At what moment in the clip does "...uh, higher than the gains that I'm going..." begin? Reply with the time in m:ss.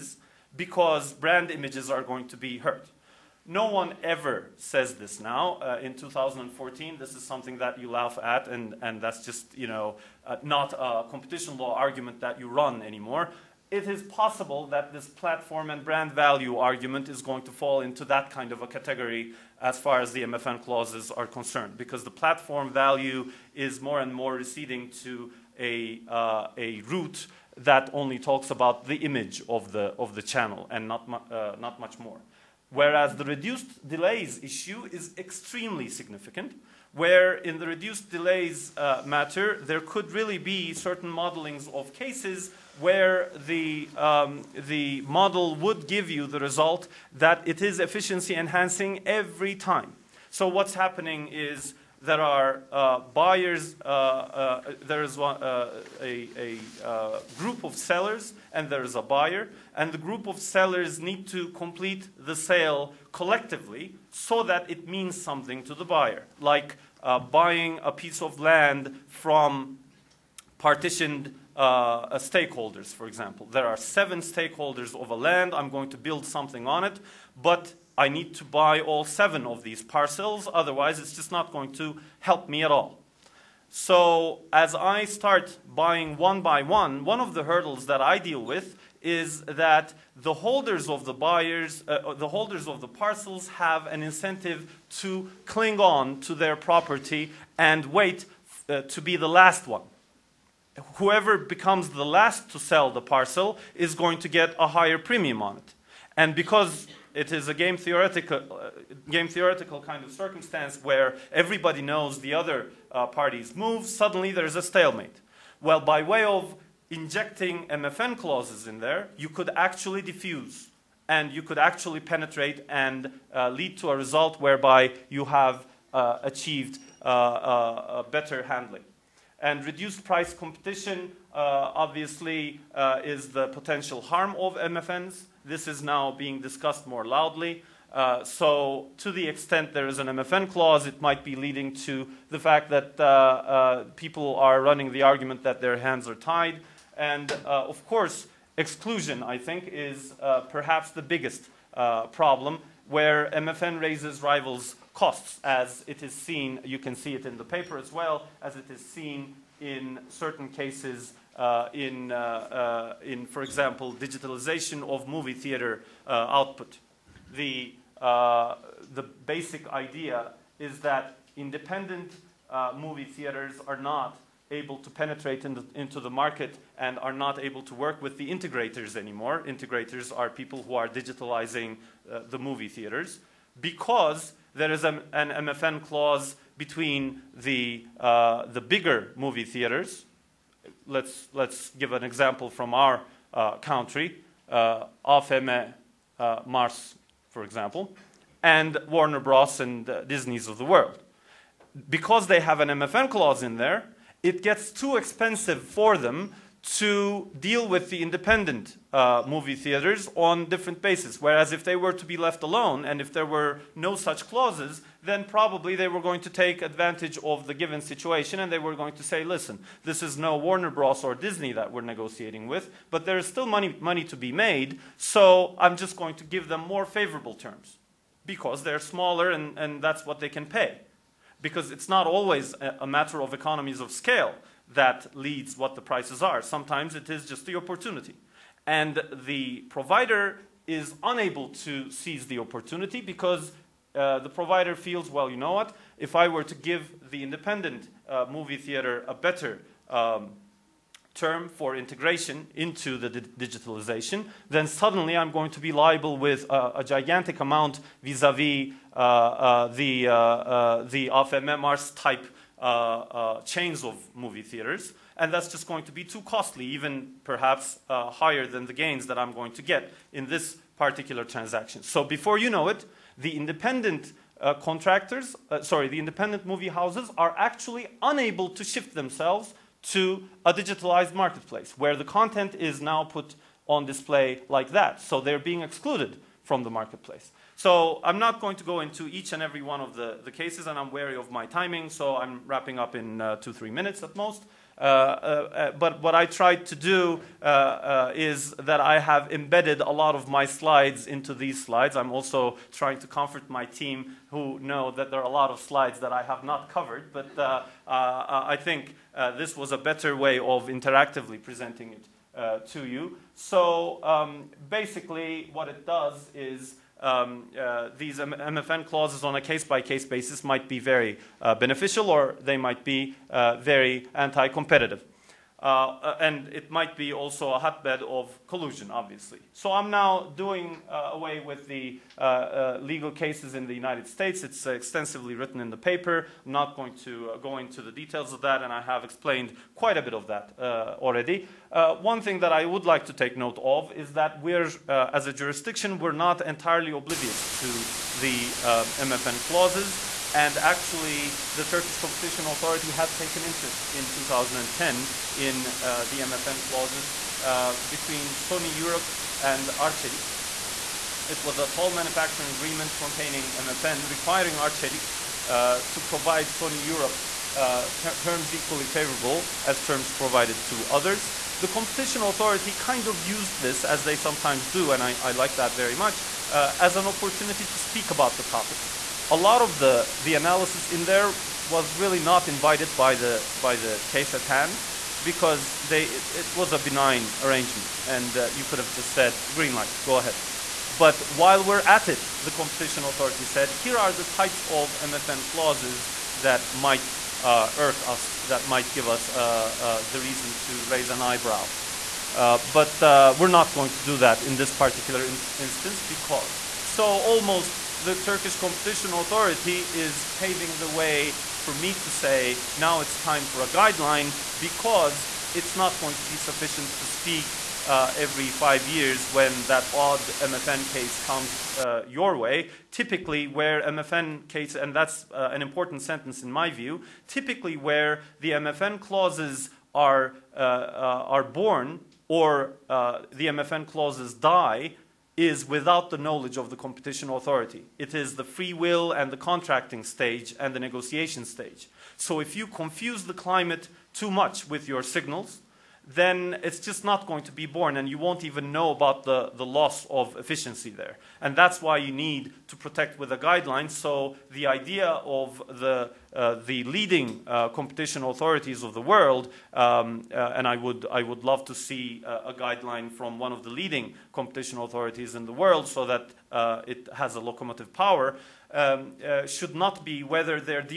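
4:27.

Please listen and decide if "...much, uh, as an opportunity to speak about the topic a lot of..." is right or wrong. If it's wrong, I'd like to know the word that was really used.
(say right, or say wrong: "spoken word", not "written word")
right.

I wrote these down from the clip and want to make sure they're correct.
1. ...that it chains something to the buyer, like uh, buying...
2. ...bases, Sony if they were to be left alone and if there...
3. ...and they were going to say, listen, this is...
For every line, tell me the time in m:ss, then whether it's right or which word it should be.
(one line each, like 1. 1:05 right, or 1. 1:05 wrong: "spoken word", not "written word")
1. 1:04 wrong: "means", not "chains"
2. 3:30 wrong: "Whereas", not "Sony"
3. 3:38 right.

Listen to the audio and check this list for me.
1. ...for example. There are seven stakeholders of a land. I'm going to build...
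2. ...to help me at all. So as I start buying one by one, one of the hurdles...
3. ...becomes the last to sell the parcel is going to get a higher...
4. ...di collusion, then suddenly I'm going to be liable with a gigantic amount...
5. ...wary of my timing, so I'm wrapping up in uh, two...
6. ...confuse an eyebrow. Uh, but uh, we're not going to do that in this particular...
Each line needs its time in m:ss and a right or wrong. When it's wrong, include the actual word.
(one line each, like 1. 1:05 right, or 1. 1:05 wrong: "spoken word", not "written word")
1. 1:12 right
2. 1:21 right
3. 1:41 right
4. 4:13 wrong: "digitalization", not "collusion"
5. 4:50 right
6. 6:40 wrong: "raise", not "confuse".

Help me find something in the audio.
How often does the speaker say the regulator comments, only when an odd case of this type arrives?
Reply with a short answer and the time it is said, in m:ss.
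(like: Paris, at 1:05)
every 5 years, at 6:58.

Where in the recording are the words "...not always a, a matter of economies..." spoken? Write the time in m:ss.
3:51.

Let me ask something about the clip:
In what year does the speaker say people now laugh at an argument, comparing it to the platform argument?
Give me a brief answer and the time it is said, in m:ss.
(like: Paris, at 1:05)
2014, at 0:05.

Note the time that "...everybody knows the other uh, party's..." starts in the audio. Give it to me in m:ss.
1:51.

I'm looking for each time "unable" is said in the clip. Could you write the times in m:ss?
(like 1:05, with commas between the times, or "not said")
4:01, 4:38.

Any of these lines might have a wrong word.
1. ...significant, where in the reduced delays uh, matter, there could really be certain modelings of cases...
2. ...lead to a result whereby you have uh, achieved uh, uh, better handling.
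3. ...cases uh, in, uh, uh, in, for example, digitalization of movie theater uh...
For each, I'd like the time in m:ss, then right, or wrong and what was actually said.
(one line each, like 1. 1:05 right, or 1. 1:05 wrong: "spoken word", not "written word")
1. 0:35 right
2. 2:03 right
3. 2:40 right.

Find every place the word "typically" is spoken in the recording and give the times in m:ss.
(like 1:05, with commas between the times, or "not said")
7:02, 7:07.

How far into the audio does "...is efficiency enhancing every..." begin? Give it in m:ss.
0:47.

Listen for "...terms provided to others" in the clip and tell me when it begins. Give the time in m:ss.
6:09.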